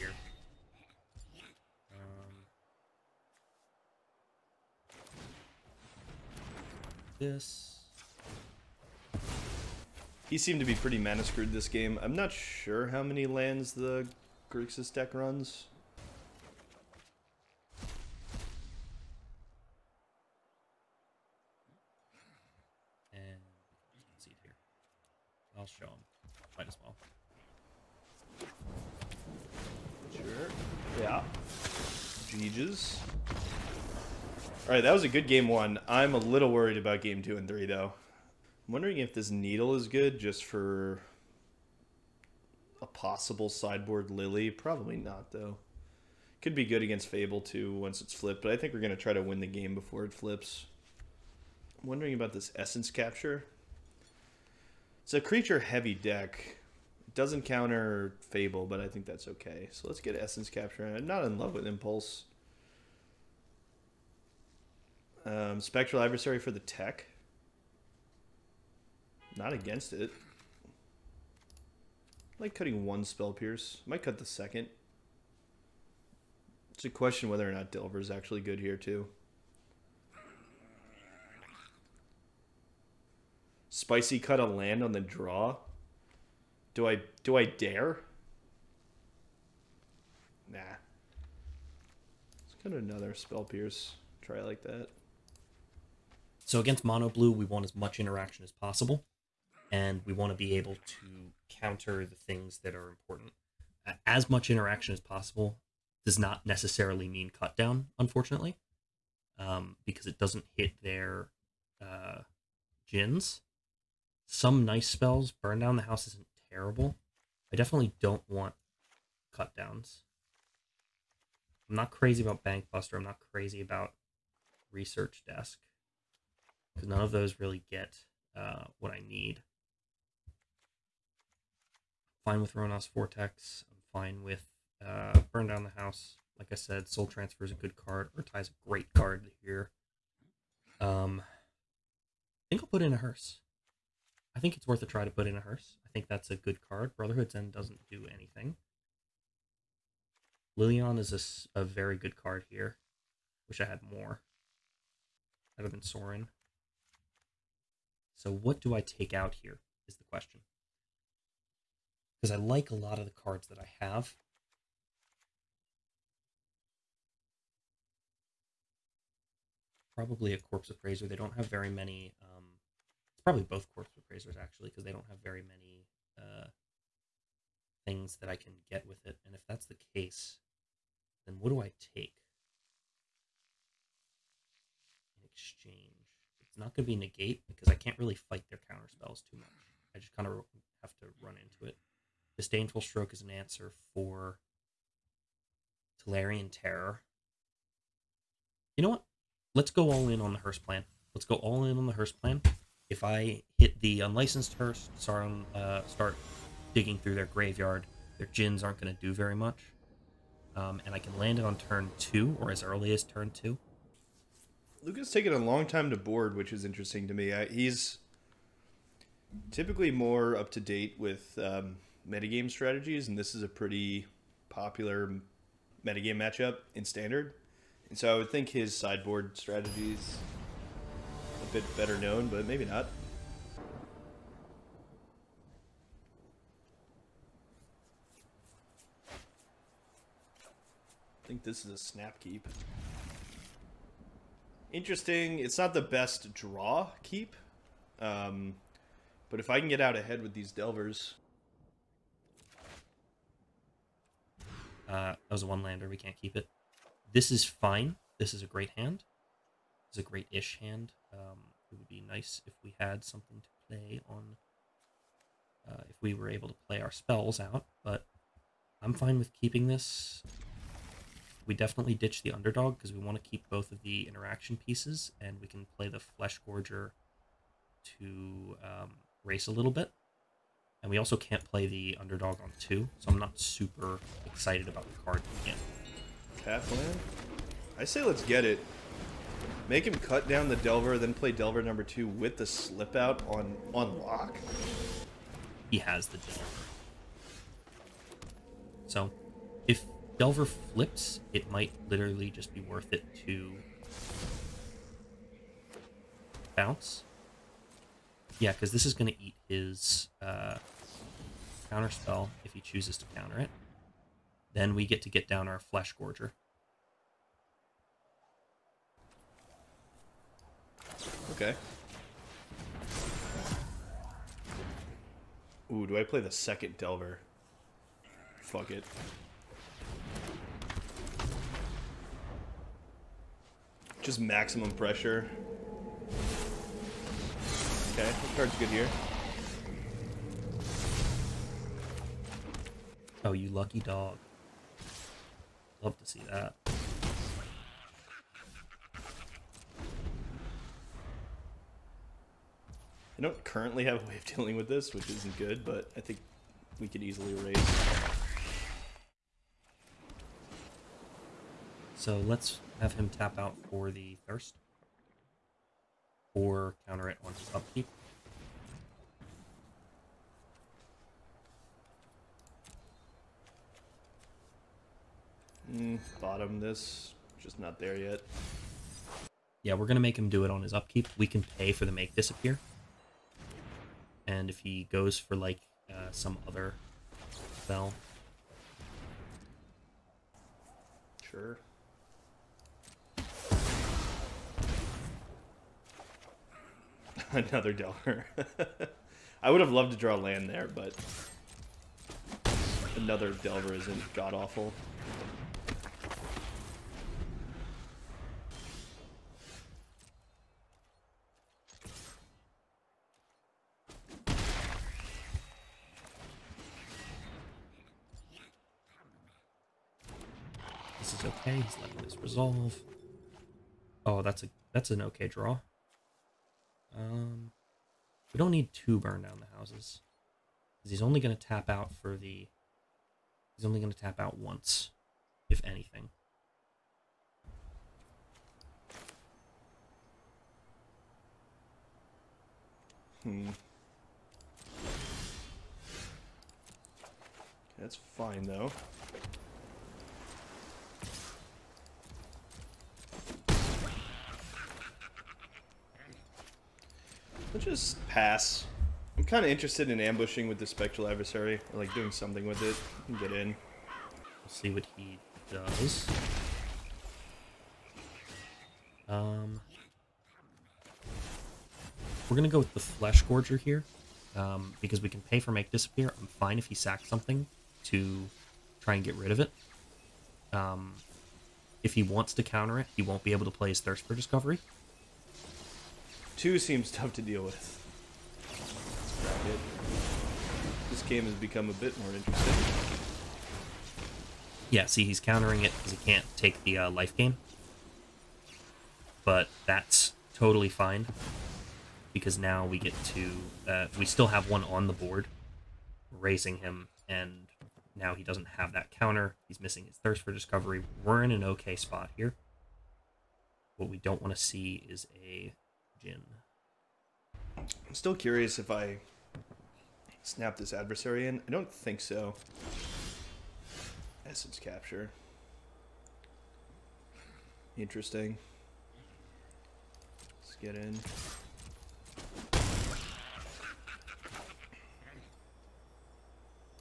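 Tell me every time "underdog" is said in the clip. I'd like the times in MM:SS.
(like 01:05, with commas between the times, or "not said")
04:32, 04:41.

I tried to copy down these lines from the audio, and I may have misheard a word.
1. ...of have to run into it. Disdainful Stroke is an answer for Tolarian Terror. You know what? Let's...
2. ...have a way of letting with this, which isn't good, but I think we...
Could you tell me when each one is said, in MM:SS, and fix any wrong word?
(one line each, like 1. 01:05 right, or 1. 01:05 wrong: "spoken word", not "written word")
1. 03:10 right
2. 05:53 wrong: "dealing", not "letting".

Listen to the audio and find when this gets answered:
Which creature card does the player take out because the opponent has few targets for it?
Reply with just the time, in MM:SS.
02:49.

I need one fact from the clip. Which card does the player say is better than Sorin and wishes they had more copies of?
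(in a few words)
Lilion.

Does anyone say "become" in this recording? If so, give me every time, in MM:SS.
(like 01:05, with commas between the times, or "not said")
08:11.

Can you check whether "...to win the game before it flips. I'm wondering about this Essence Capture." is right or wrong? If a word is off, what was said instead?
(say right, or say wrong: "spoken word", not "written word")
right.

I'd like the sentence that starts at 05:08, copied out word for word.
Yeah, because this is going to eat his uh, counter spell if he chooses to counter it.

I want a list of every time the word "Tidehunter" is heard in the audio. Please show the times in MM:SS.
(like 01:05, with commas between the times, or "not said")
not said.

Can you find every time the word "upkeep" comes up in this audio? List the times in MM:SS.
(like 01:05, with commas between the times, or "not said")
06:07, 06:20.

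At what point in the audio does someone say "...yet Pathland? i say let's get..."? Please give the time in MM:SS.
04:45.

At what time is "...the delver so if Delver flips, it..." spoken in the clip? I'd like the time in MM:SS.
04:56.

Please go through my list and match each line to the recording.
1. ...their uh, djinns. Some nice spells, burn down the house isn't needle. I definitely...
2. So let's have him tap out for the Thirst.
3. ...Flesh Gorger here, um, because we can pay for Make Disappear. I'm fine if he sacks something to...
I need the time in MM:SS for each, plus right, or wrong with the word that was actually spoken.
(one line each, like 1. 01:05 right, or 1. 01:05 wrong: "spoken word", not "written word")
1. 01:50 wrong: "terrible", not "needle"
2. 06:01 right
3. 07:52 right.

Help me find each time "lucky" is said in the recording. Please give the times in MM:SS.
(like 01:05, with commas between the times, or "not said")
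05:43.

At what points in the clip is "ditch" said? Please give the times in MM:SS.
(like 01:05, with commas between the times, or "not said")
04:31.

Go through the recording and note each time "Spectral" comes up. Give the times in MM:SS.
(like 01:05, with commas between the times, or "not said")
01:05, 07:40.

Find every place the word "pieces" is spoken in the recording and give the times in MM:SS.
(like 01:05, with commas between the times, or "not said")
04:34.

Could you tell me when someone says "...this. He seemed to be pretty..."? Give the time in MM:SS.
00:07.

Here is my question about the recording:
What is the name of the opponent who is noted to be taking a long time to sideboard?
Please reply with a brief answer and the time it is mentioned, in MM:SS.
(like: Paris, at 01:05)
Luca, at 03:34.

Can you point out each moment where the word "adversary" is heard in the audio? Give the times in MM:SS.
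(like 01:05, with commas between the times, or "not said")
01:06, 07:41, 08:40.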